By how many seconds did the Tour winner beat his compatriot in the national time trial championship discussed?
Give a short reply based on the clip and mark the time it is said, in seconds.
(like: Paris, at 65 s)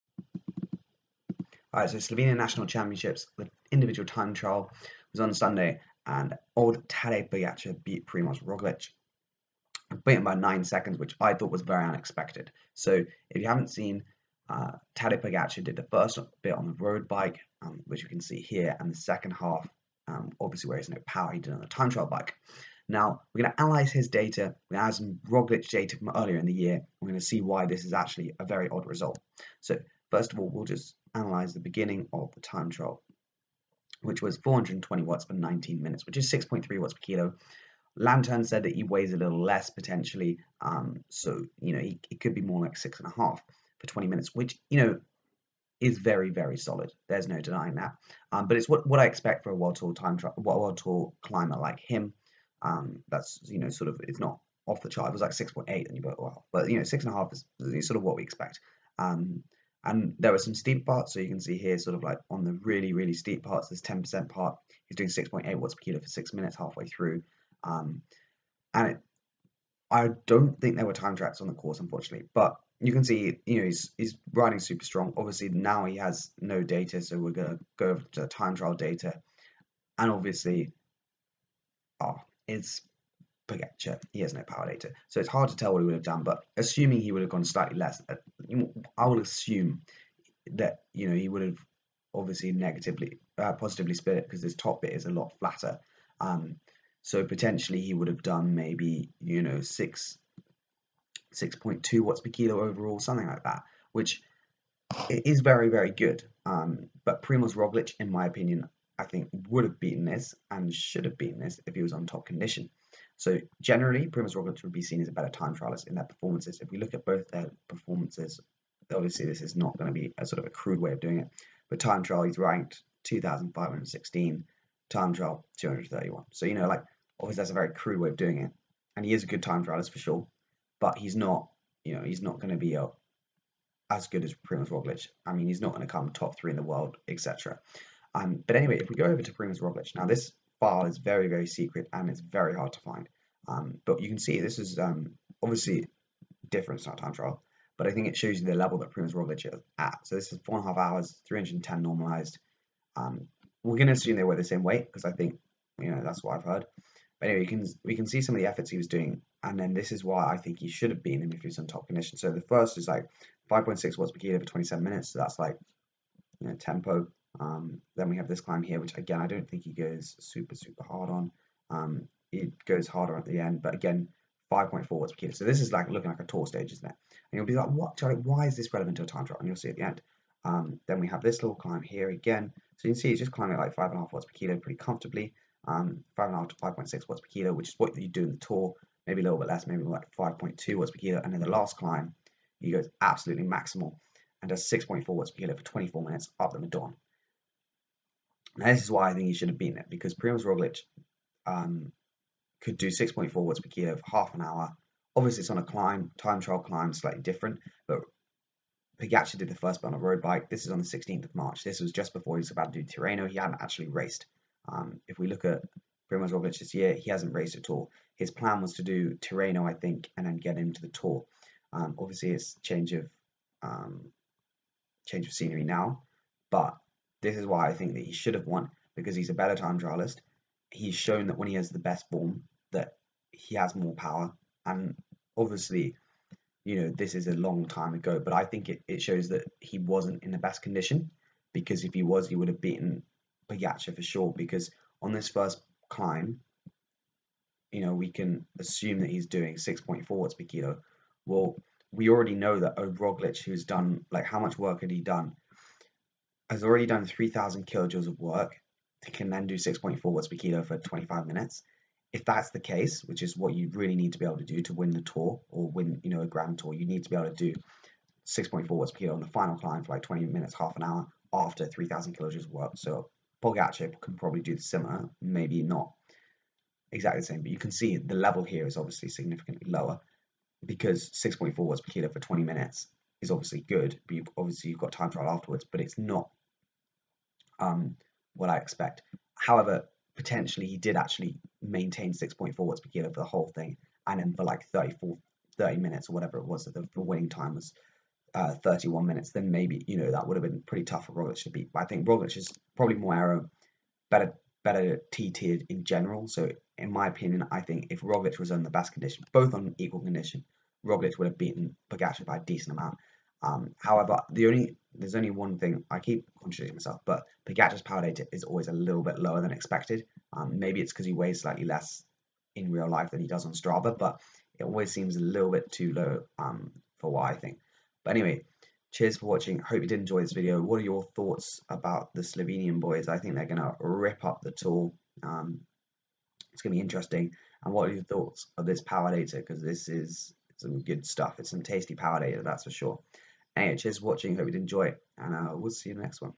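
9, at 10 s.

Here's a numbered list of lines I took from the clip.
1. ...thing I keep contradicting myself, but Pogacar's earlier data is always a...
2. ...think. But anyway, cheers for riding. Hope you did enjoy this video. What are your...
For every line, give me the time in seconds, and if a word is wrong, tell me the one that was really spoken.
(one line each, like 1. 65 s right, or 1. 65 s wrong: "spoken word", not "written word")
1. 315 s wrong: "power", not "earlier"
2. 327 s wrong: "watching", not "riding".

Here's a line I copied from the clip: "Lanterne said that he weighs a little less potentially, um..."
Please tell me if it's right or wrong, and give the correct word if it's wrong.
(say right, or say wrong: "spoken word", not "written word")
right.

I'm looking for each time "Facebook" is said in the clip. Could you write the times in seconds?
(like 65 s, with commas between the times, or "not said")
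not said.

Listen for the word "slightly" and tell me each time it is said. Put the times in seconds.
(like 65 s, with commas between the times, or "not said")
87 s, 206 s, 321 s.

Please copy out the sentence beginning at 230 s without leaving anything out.
He's shown that when he has the best form, that he has more power.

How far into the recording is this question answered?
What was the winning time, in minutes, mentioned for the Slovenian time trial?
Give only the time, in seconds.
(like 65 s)
298 s.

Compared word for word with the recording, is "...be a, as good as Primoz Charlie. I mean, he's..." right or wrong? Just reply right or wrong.
wrong.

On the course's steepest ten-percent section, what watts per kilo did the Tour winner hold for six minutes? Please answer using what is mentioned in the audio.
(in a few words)
6.8.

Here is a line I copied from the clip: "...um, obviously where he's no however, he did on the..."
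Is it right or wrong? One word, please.
wrong.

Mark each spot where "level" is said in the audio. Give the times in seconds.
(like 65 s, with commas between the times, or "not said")
148 s, 278 s.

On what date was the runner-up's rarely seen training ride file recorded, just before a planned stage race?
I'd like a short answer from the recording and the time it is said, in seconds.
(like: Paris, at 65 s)
16 March, at 210 s.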